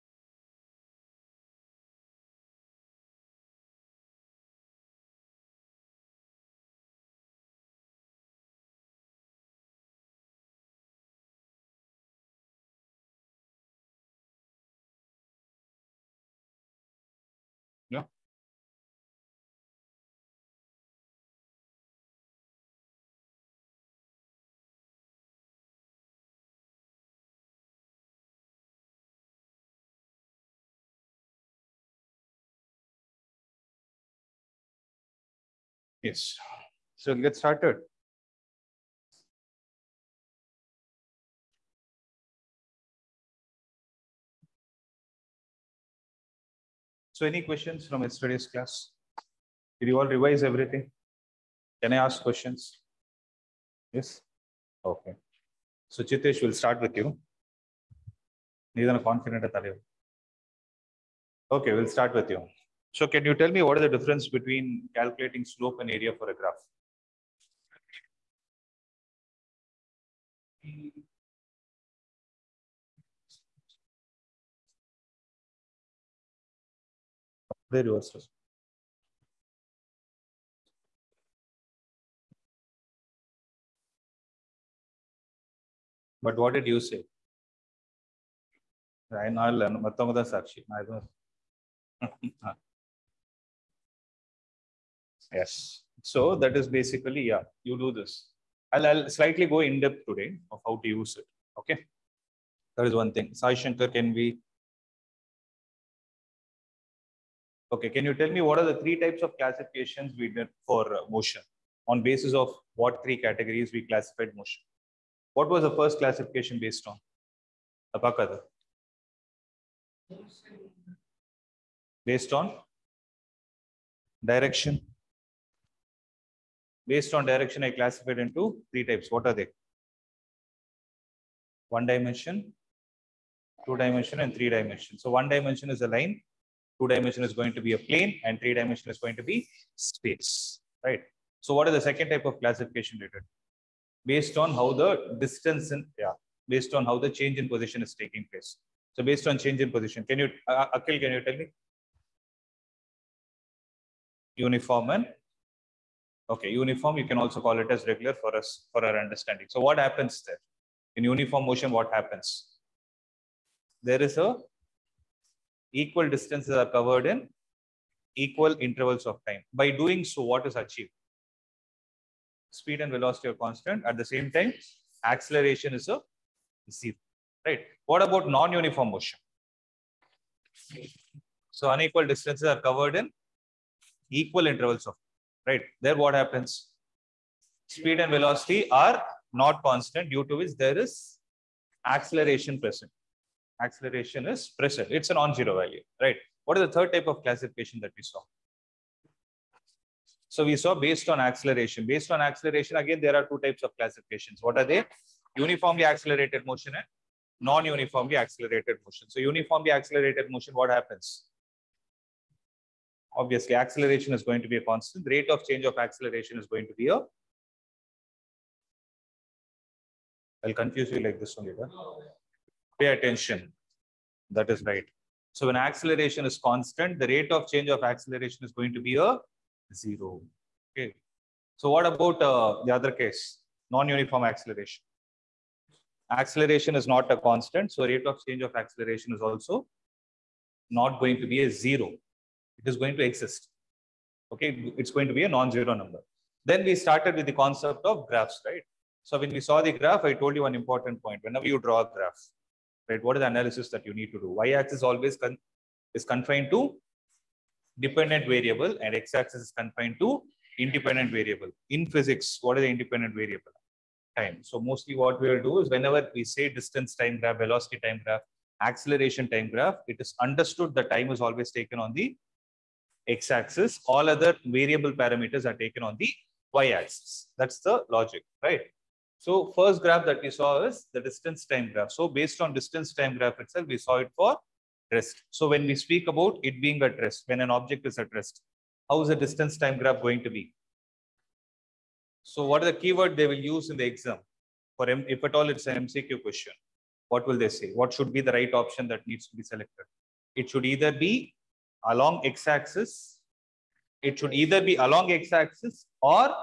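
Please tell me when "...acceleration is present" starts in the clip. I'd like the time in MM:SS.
03:13.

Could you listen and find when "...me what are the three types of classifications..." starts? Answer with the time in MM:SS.
01:48.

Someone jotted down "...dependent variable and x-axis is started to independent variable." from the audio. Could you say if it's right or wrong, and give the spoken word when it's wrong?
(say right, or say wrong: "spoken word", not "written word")
wrong: "confined", not "started".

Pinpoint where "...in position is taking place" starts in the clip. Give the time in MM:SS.
02:27.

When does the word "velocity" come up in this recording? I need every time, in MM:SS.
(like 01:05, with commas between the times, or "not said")
02:52, 03:08, 04:27.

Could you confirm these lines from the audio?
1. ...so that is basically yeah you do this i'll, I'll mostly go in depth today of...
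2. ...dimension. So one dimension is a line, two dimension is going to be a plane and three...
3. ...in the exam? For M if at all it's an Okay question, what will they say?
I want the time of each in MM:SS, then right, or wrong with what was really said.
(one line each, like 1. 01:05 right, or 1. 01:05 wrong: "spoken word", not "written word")
1. 01:36 wrong: "slightly", not "mostly"
2. 02:14 right
3. 04:53 wrong: "MCQ", not "Okay".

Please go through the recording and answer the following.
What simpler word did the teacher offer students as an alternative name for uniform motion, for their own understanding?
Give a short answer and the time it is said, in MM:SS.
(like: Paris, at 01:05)
Regular, at 02:37.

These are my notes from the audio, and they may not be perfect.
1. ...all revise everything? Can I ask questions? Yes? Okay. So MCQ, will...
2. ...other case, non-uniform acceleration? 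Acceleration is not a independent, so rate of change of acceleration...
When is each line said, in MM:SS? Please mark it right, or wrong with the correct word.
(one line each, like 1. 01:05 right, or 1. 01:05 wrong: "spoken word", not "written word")
1. 00:49 wrong: "Chitesh", not "MCQ"
2. 03:52 wrong: "constant", not "independent".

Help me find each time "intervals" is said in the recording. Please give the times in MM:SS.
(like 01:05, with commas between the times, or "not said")
02:48, 03:04.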